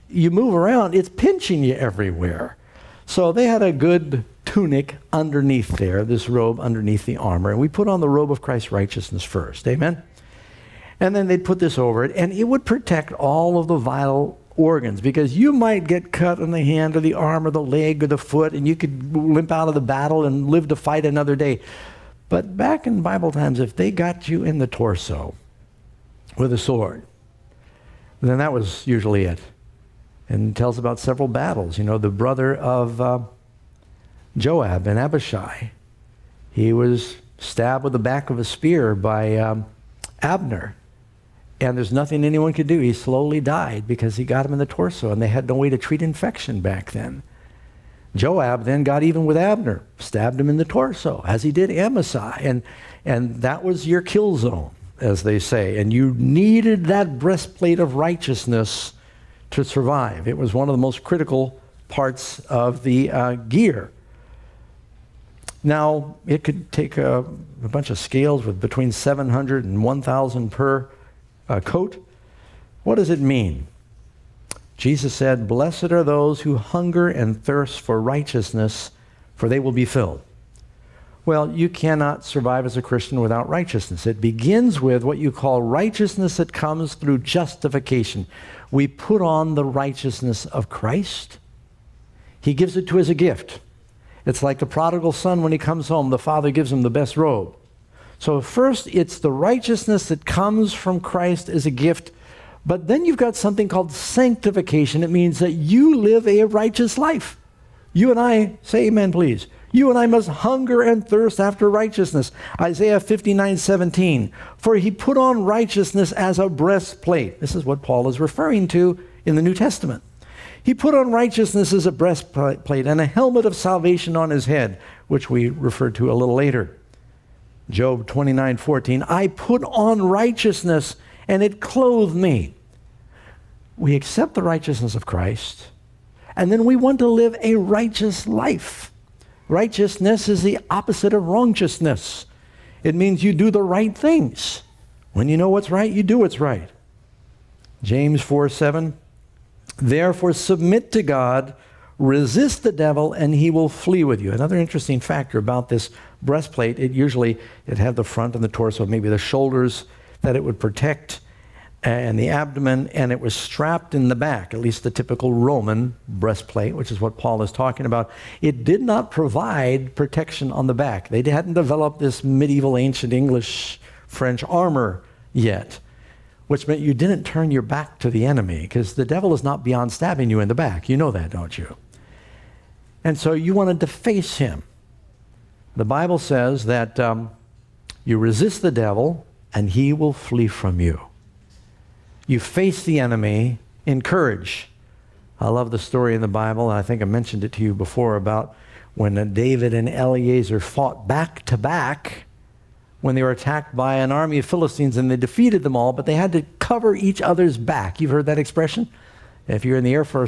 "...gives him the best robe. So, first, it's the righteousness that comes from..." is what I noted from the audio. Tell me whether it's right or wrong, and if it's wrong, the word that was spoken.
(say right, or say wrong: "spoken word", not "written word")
right.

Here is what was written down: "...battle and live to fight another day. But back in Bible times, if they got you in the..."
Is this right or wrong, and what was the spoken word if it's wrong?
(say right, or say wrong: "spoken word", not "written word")
right.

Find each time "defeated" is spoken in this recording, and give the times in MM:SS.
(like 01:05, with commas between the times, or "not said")
03:25.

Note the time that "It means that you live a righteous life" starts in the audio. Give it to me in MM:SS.
01:45.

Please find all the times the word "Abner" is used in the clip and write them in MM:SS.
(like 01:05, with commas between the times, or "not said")
00:40, 00:49.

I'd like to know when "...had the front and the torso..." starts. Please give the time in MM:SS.
02:37.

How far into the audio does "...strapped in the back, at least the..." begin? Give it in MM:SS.
02:43.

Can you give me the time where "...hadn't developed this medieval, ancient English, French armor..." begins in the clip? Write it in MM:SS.
02:51.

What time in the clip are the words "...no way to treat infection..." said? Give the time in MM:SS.
00:45.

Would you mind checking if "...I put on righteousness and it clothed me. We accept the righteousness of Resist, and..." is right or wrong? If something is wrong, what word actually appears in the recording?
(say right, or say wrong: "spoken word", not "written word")
wrong: "Christ", not "Resist".